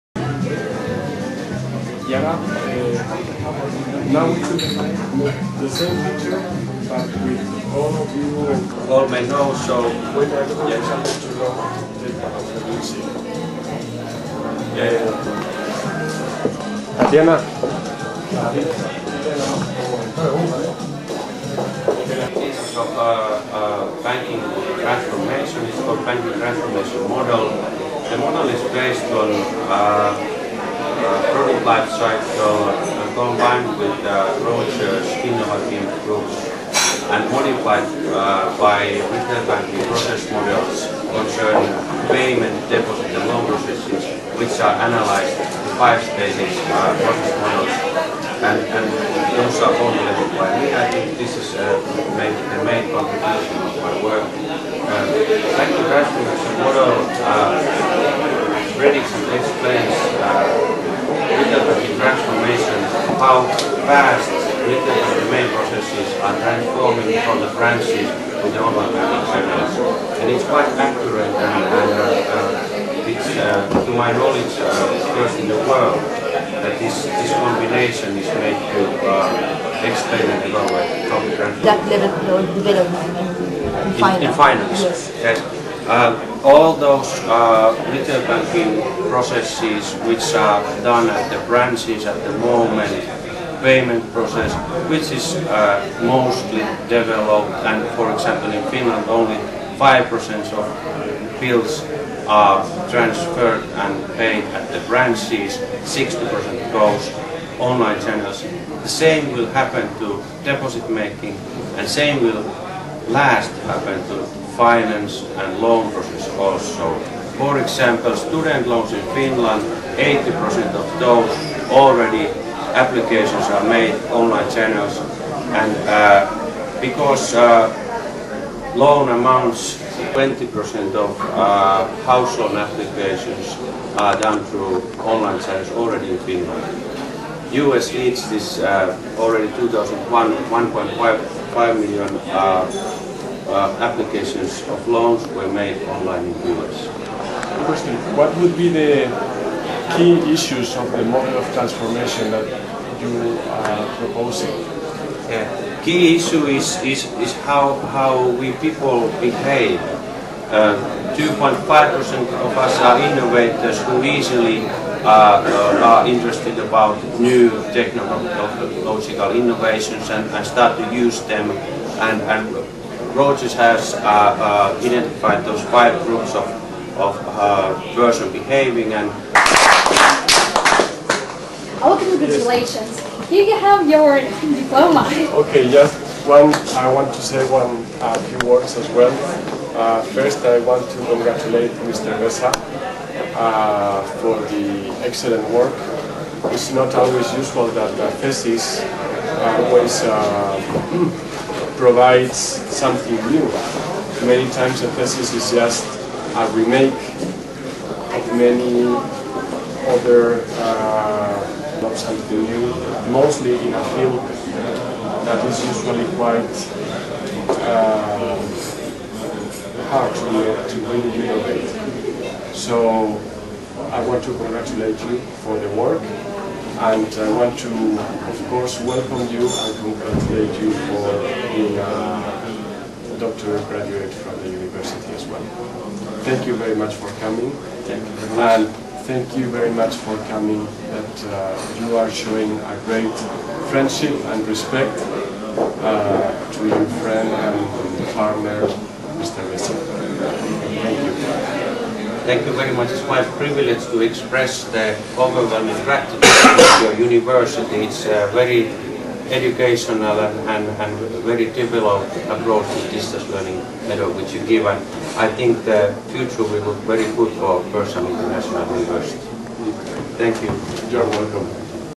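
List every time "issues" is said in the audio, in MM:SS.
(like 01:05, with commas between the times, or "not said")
02:30, 02:36.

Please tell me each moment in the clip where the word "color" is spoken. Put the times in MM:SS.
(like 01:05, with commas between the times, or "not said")
00:32.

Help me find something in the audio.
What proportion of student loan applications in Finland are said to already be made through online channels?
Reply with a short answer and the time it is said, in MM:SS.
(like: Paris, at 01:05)
80%, at 01:59.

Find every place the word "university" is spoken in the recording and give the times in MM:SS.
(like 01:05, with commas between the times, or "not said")
03:54, 04:17, 04:28.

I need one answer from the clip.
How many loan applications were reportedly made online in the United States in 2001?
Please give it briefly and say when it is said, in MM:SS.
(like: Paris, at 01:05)
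1.5 million, at 02:20.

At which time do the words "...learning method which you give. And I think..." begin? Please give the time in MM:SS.
04:23.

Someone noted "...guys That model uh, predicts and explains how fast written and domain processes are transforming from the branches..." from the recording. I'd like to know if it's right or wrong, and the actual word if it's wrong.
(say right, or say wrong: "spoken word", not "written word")
wrong: "The", not "That".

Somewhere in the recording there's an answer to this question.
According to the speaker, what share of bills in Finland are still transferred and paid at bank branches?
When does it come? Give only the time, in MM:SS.
01:39.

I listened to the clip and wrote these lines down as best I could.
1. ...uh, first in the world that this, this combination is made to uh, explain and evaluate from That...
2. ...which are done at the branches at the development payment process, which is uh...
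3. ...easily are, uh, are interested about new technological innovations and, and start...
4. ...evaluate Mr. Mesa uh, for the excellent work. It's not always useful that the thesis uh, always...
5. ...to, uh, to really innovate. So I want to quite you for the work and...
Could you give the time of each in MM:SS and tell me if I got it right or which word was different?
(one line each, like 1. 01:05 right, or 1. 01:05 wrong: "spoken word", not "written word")
1. 01:14 right
2. 01:30 wrong: "moment", not "development"
3. 02:44 right
4. 03:11 wrong: "congratulate", not "evaluate"
5. 03:40 wrong: "congratulate", not "quite".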